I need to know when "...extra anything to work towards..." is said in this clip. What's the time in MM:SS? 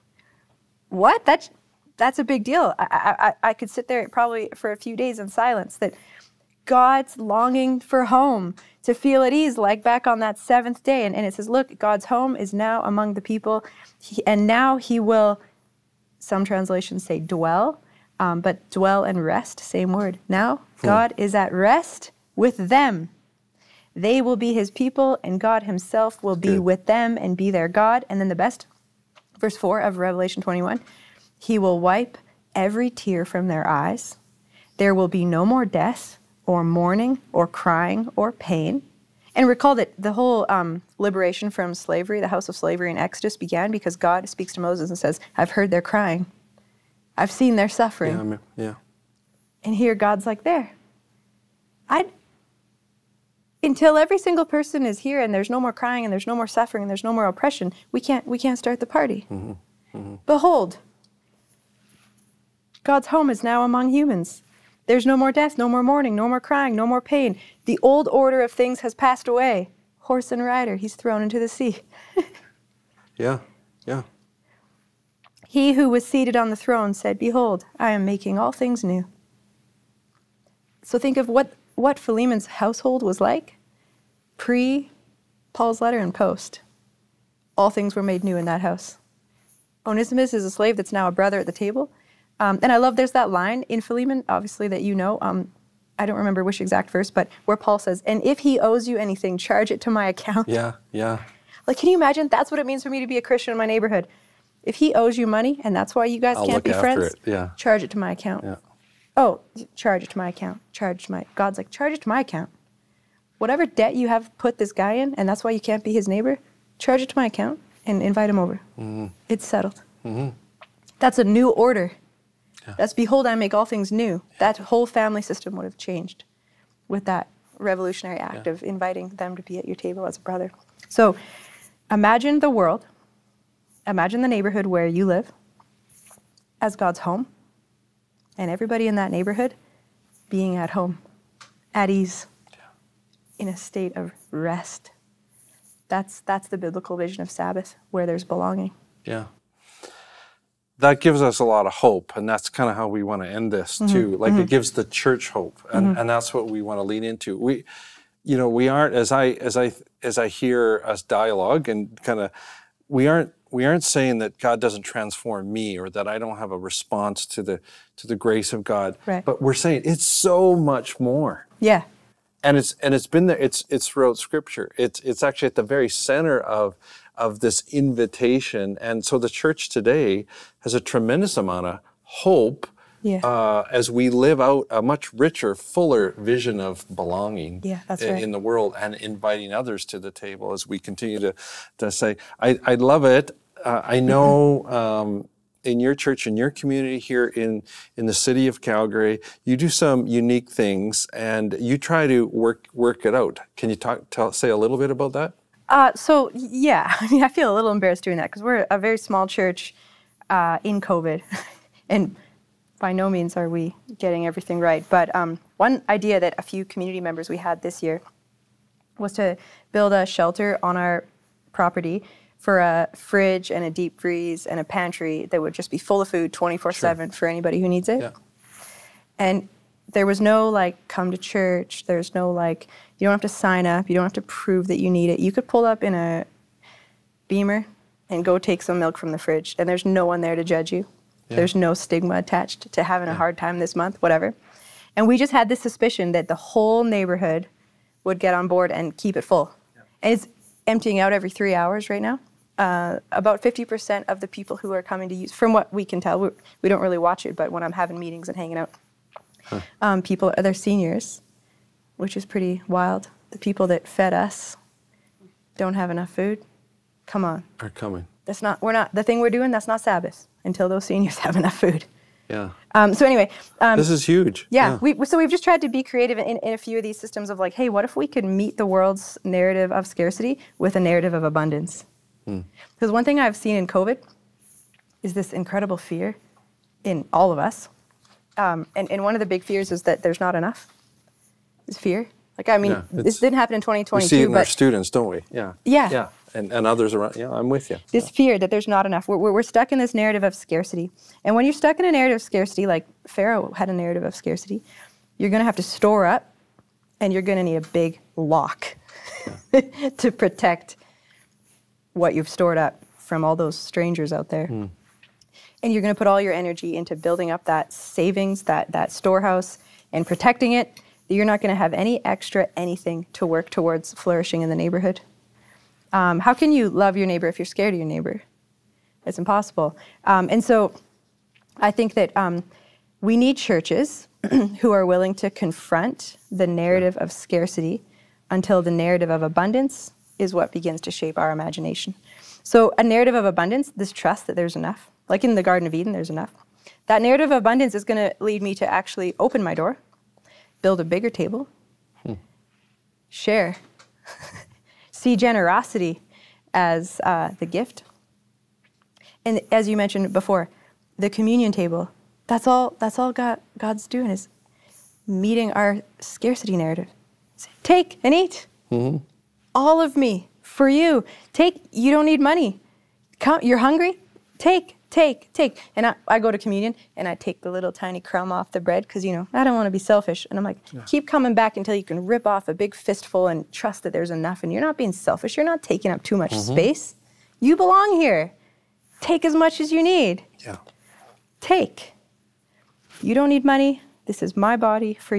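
05:22.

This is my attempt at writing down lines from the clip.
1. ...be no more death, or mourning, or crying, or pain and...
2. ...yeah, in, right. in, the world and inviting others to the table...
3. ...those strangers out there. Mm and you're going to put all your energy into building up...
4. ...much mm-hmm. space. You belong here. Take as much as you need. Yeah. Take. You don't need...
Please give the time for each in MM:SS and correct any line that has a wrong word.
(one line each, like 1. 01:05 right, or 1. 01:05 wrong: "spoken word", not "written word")
1. 00:35 right
2. 03:07 right
3. 05:13 right
4. 06:26 right.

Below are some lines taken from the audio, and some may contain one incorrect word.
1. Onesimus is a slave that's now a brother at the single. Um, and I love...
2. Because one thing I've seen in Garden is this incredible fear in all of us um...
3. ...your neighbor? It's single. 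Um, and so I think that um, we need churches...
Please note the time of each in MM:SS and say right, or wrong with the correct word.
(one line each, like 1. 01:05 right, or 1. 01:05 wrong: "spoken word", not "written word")
1. 01:29 wrong: "table", not "single"
2. 04:42 wrong: "COVID", not "Garden"
3. 05:27 wrong: "impossible", not "single".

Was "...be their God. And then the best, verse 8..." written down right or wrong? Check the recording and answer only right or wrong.
wrong.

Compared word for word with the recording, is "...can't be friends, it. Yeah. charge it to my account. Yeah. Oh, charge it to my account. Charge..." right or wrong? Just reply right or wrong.
right.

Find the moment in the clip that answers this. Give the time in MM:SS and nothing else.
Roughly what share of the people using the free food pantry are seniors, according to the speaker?
04:13.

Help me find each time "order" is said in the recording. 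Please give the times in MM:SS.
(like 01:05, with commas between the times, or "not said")
01:08, 02:01.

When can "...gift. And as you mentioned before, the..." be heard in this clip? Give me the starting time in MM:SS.
05:57.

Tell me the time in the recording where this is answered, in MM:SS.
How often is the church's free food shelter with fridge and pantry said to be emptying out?
04:11.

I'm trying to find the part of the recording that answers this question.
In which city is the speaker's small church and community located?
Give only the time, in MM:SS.
03:18.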